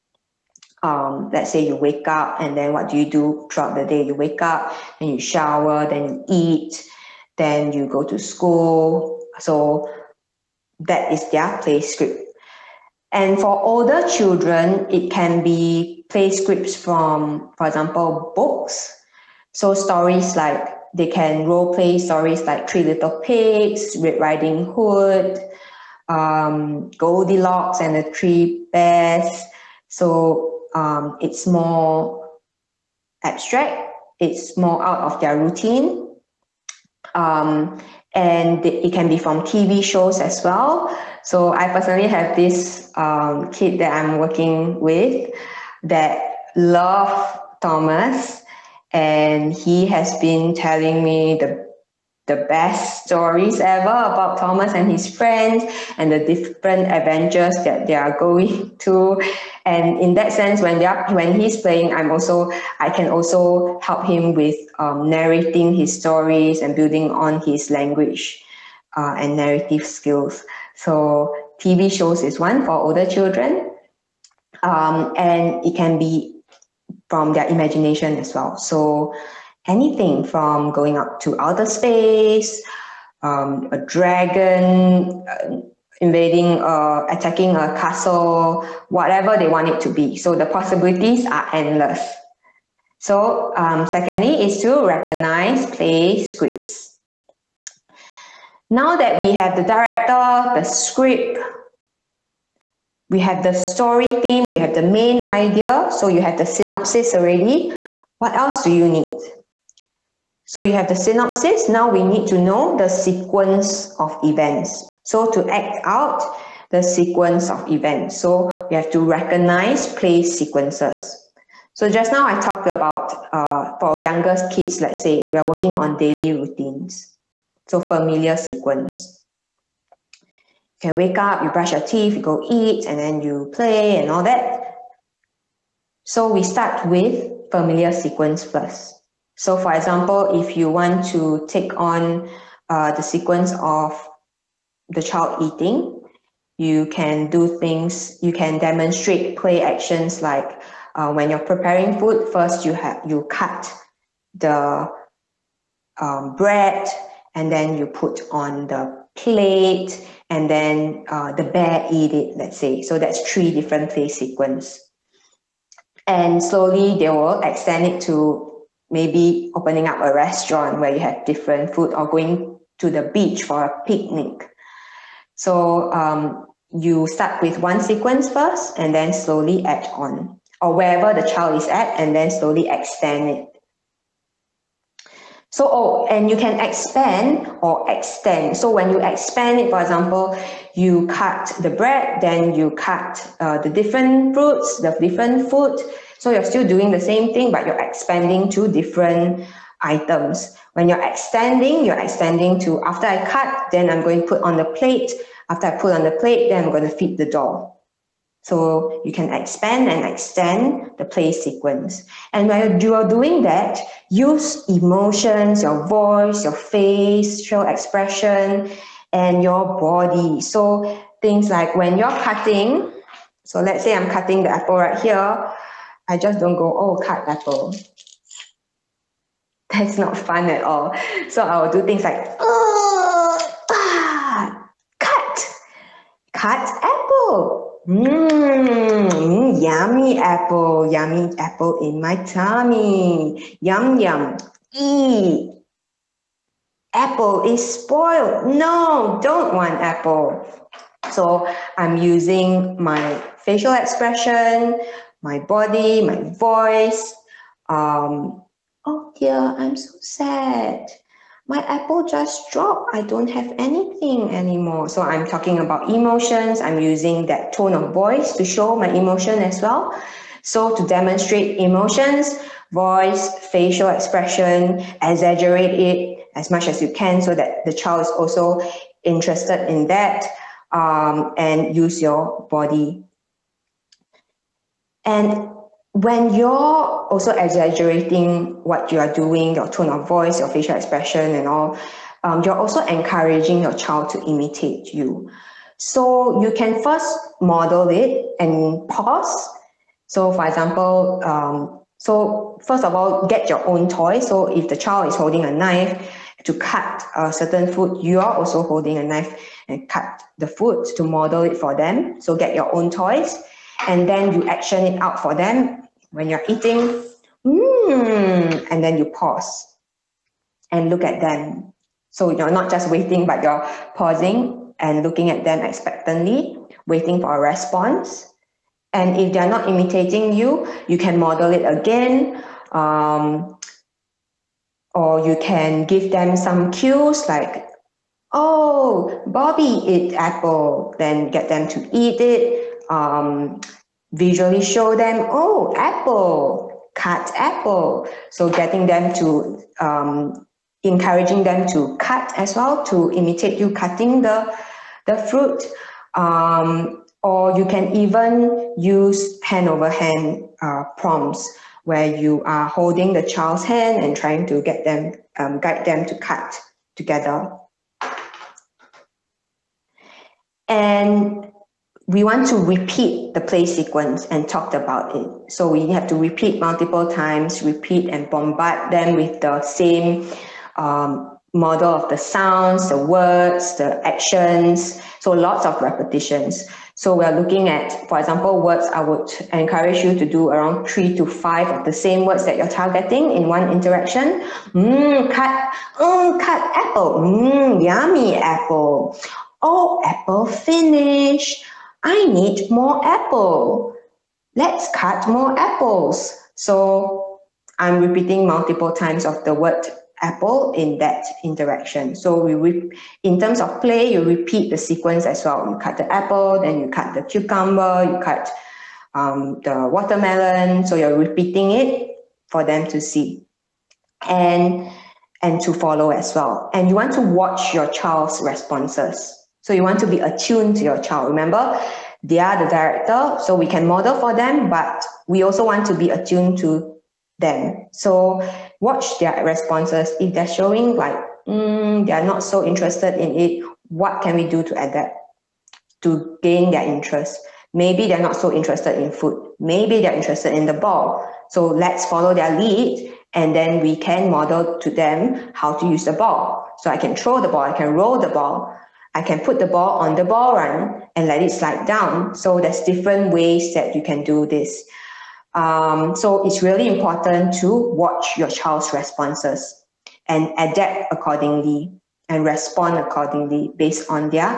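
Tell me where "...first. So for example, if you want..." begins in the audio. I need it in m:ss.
2:18.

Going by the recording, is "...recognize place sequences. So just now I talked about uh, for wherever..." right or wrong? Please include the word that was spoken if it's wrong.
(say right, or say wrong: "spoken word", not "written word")
wrong: "younger", not "wherever".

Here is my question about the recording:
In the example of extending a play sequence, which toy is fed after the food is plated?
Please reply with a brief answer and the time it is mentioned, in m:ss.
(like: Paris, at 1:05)
the doll, at 3:27.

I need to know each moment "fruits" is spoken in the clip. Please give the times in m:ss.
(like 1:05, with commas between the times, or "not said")
3:14, 5:55.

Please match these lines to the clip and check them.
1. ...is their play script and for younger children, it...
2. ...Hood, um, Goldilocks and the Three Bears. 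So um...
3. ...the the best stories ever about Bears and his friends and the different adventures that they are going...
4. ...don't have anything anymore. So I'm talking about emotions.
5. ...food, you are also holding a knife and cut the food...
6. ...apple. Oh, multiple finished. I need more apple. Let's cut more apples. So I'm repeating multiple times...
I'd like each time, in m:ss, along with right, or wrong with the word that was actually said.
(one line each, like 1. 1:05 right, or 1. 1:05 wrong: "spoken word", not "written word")
1. 0:11 wrong: "older", not "younger"
2. 0:24 right
3. 0:51 wrong: "Thomas", not "Bears"
4. 4:23 right
5. 5:07 right
6. 6:38 wrong: "apple", not "multiple".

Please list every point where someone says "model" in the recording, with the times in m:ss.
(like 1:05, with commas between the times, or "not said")
4:57, 5:11, 5:31, 6:21, 7:13, 7:34.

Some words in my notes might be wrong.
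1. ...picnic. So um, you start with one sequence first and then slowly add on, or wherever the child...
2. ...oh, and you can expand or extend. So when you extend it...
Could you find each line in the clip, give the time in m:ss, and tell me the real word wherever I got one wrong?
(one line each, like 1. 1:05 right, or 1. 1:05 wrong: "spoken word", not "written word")
1. 2:53 right
2. 3:05 wrong: "expand", not "extend".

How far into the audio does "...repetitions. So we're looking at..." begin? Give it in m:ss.
6:25.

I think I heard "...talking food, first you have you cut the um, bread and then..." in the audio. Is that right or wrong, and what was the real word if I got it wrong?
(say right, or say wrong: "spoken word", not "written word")
wrong: "preparing", not "talking".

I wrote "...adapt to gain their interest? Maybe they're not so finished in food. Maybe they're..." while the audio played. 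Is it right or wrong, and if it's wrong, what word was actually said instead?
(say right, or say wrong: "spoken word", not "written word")
wrong: "interested", not "finished".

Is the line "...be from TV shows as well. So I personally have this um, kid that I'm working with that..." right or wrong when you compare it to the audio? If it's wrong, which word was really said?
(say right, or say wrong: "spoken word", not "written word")
right.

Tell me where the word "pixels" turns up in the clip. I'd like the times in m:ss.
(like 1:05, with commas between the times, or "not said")
not said.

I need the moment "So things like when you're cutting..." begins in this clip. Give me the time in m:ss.
3:40.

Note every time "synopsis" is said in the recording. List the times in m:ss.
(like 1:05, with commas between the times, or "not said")
1:46, 1:50.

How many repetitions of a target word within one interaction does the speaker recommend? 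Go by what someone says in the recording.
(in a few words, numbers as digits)
3 to 5.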